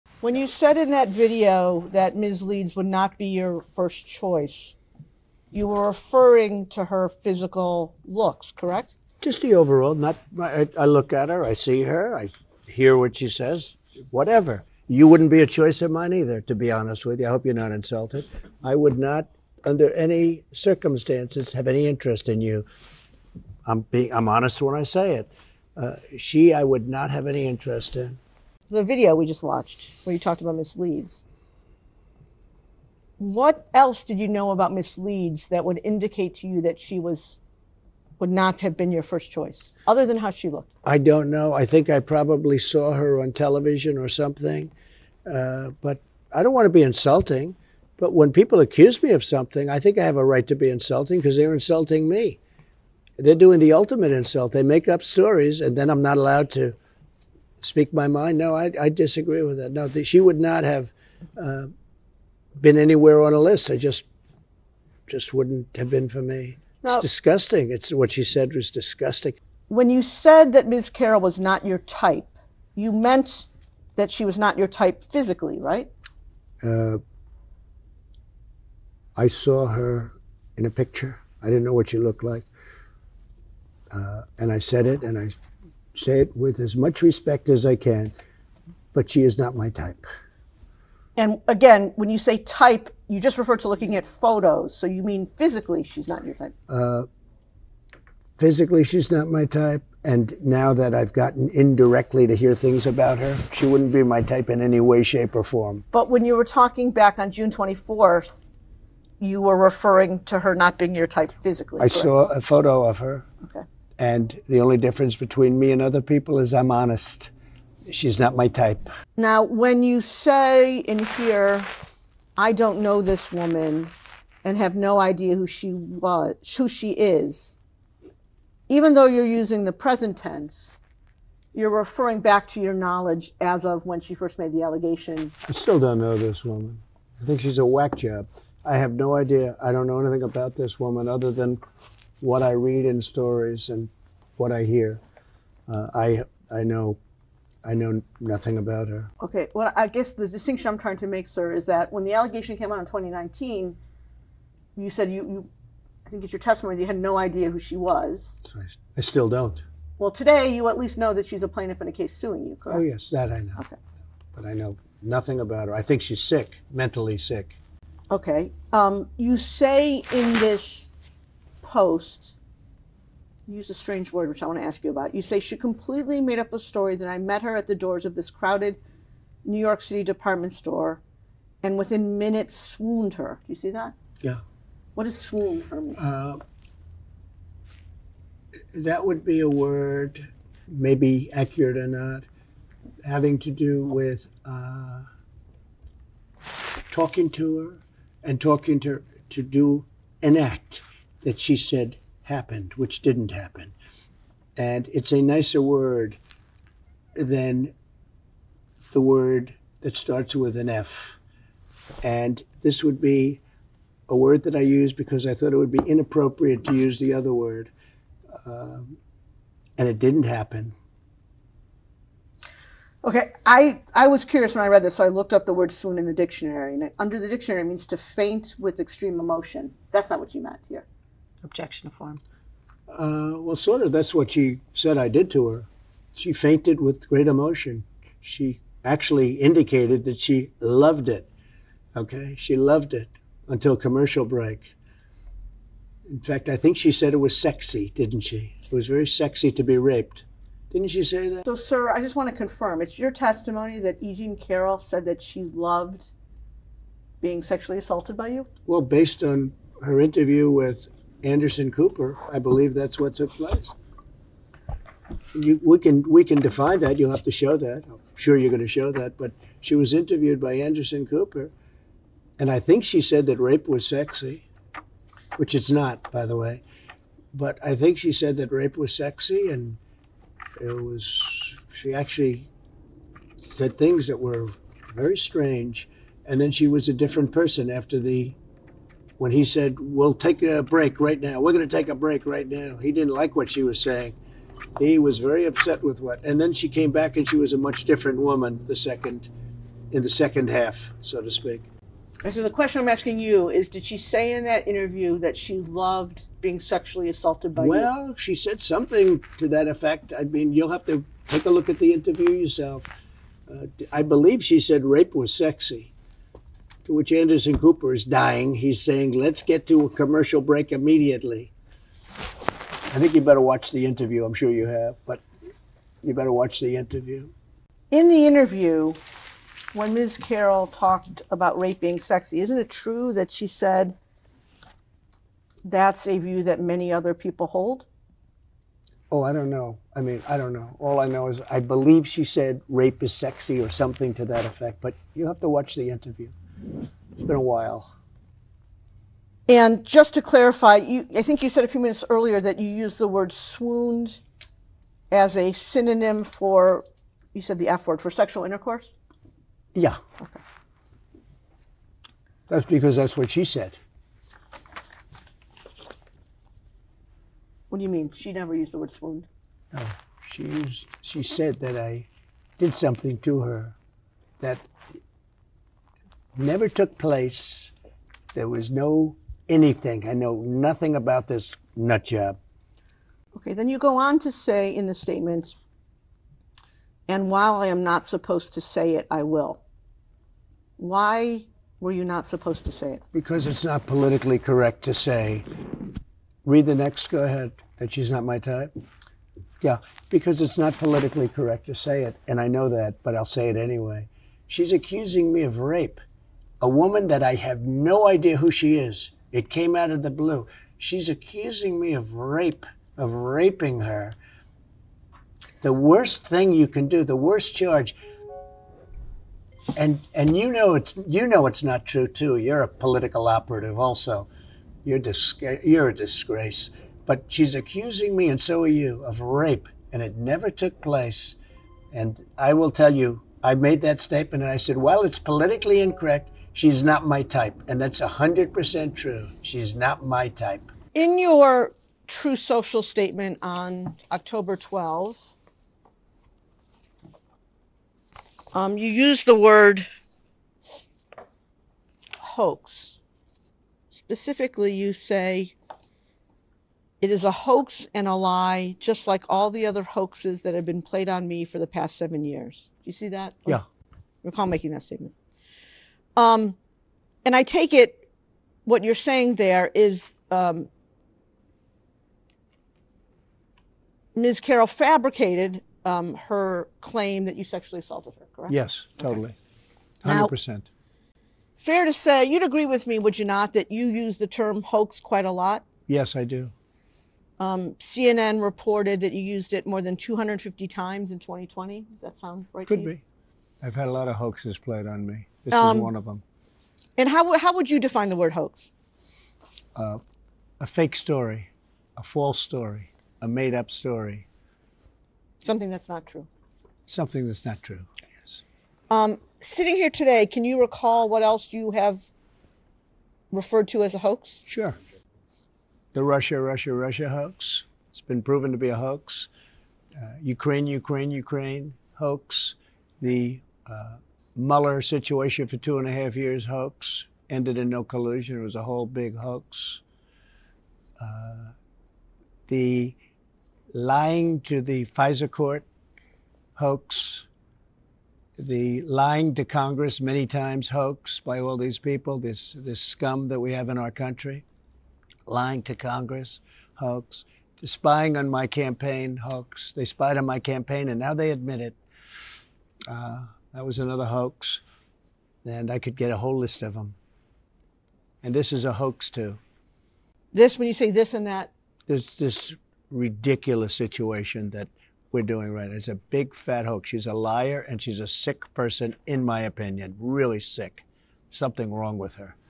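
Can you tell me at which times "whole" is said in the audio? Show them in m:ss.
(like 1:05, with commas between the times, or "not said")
8:48, 9:16.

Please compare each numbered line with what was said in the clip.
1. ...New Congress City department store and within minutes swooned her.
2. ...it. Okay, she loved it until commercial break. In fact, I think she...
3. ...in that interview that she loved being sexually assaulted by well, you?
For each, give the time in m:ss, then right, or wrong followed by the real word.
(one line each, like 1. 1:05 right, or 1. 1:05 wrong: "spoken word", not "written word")
1. 2:59 wrong: "York", not "Congress"
2. 4:01 right
3. 5:04 right.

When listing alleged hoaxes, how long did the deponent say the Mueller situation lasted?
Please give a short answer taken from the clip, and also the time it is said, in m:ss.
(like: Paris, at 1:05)
two and a half years, at 8:45.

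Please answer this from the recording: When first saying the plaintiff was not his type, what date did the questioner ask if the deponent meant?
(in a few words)
June 24th.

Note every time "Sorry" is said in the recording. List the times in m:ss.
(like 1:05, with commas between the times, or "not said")
2:38.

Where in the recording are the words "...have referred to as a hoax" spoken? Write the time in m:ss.
8:31.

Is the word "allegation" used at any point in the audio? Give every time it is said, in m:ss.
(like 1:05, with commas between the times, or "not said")
2:14, 2:32.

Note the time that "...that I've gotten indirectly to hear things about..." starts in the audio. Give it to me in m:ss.
1:40.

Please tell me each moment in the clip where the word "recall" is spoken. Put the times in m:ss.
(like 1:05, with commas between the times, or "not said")
7:44, 8:30.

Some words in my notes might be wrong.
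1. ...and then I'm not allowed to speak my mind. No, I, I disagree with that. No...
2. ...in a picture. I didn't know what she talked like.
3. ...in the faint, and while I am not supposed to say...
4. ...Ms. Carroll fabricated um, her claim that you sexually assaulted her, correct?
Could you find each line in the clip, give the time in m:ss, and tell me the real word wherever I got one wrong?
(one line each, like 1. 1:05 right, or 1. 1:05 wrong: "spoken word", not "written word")
1. 0:55 right
2. 1:20 wrong: "looked", not "talked"
3. 6:24 wrong: "statement", not "faint"
4. 7:54 right.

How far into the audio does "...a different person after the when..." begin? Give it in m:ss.
4:46.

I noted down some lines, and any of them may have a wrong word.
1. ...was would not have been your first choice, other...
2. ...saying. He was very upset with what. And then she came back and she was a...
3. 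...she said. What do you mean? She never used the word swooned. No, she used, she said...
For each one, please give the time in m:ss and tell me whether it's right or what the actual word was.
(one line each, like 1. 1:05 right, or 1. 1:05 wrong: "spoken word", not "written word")
1. 0:36 right
2. 4:53 right
3. 6:03 right.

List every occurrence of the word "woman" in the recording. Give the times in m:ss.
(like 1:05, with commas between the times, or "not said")
2:03, 2:16, 2:20, 4:58, 6:46.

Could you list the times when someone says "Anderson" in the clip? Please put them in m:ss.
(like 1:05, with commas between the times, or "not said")
4:21, 4:30, 5:17.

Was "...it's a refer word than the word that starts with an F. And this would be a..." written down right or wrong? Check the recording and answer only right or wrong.
wrong.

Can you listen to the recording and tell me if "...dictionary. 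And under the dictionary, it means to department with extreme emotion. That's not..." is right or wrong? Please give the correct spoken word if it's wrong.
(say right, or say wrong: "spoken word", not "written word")
wrong: "faint", not "department".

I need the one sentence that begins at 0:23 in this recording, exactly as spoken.
I'm being I'm honest when I say it.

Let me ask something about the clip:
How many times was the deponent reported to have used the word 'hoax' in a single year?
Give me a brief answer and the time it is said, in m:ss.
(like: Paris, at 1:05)
more than 250, at 8:09.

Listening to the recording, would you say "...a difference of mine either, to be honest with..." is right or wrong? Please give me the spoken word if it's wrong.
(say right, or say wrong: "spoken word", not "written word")
wrong: "choice", not "difference".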